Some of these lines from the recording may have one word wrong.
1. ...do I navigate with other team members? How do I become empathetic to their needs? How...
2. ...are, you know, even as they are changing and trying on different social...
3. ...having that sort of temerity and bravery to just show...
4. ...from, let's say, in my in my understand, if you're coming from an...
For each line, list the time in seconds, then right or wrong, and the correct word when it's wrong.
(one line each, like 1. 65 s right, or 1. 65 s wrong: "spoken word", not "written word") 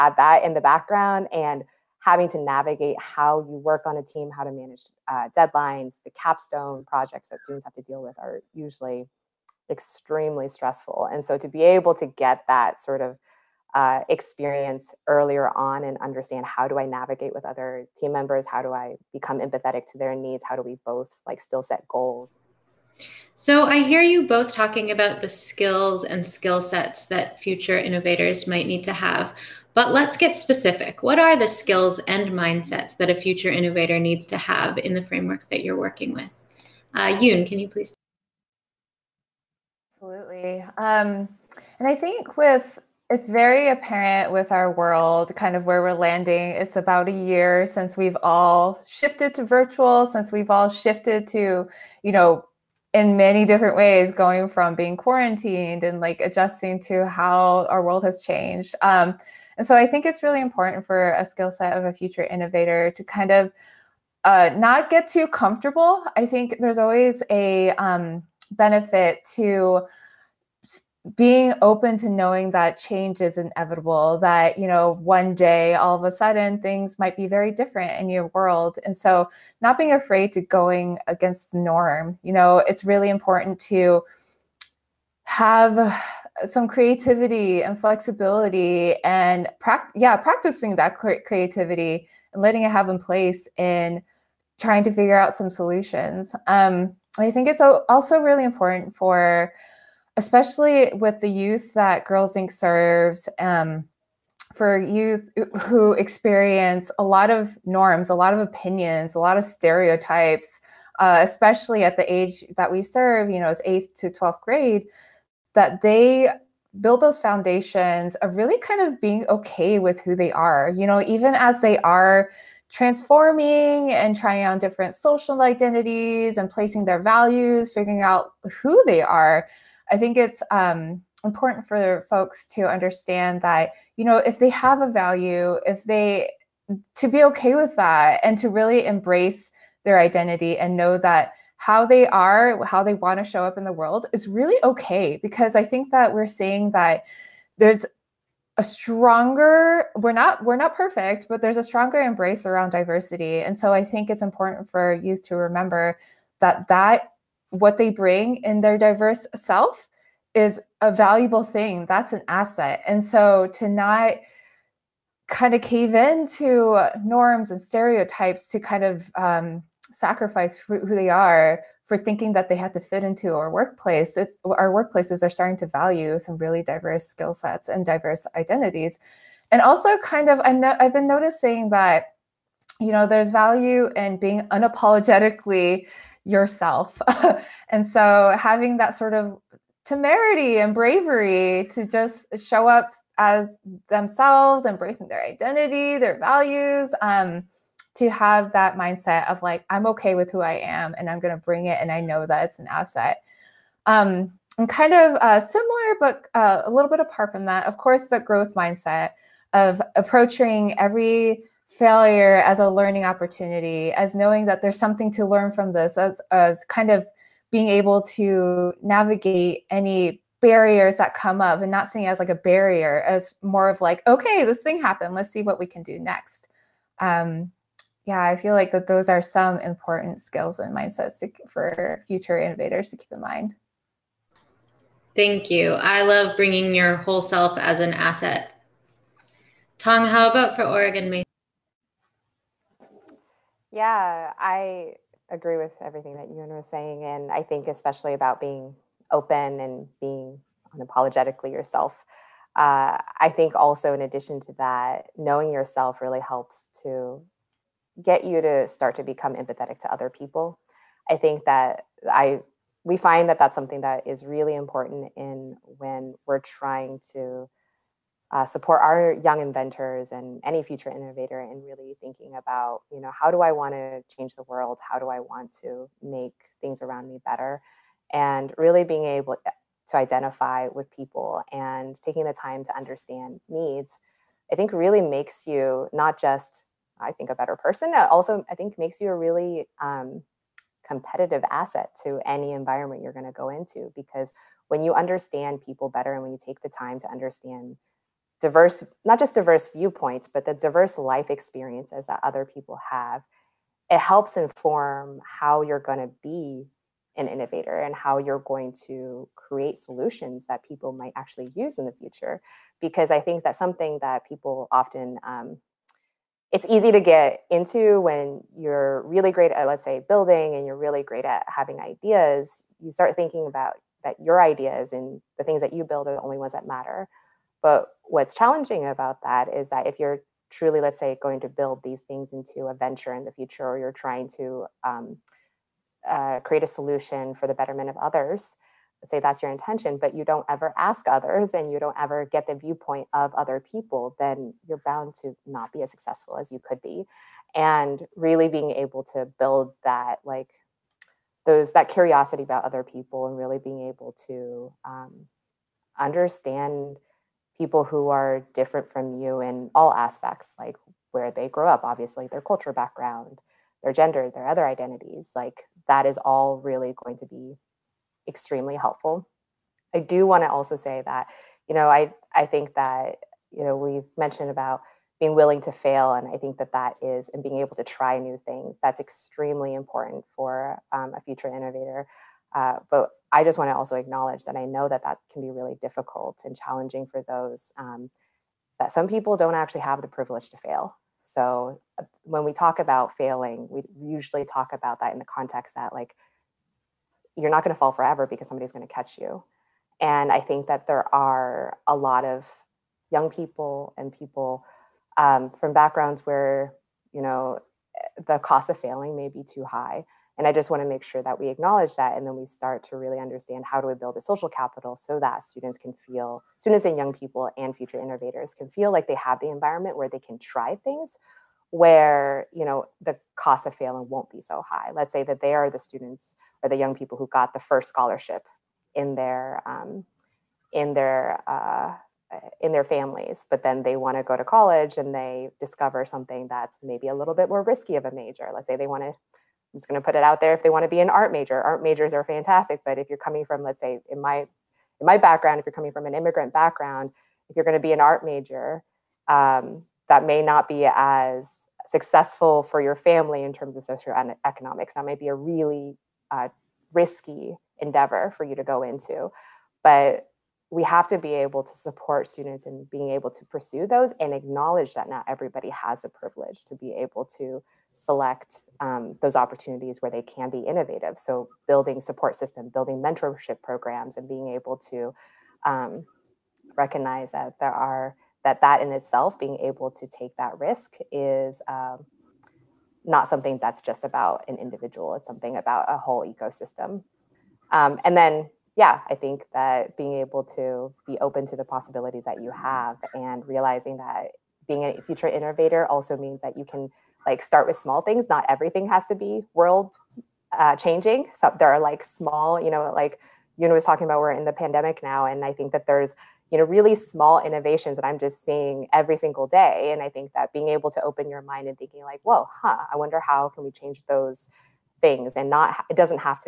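1. 16 s right
2. 120 s wrong: "transforming", not "changing"
3. 188 s right
4. 443 s wrong: "background", not "understand".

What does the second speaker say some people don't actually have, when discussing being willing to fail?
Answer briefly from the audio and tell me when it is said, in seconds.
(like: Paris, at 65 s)
the privilege to fail, at 390 s.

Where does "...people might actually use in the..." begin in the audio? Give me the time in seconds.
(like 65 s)
310 s.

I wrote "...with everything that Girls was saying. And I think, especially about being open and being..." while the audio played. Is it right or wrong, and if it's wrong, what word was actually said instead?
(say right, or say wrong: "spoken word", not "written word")
wrong: "Youn", not "Girls".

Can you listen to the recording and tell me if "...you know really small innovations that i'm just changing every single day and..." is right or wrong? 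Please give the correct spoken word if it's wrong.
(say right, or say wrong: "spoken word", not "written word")
wrong: "seeing", not "changing".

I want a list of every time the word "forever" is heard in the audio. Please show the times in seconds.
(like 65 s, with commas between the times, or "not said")
397 s.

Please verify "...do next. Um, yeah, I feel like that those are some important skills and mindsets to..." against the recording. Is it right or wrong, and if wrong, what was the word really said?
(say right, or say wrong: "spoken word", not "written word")
right.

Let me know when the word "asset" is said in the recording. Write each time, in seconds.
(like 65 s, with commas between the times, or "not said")
162 s, 202 s, 237 s, 291 s.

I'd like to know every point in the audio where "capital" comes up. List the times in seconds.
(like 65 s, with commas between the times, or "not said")
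414 s.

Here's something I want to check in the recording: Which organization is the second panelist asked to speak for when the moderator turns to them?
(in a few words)
Oregon Mesa.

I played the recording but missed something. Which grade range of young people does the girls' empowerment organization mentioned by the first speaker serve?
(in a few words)
8th to 12th grade.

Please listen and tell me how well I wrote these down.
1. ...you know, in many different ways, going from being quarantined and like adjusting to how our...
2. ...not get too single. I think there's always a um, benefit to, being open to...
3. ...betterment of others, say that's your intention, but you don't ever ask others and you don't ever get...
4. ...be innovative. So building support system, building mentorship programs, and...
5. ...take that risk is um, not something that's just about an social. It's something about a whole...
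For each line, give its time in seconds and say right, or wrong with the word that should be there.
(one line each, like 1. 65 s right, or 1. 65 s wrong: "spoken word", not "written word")
1. 52 s right
2. 64 s wrong: "comfortable", not "single"
3. 337 s right
4. 470 s right
5. 480 s wrong: "individual", not "social".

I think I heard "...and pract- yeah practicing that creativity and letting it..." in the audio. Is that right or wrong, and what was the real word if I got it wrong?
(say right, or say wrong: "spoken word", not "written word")
right.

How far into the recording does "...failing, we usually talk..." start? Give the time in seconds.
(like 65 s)
393 s.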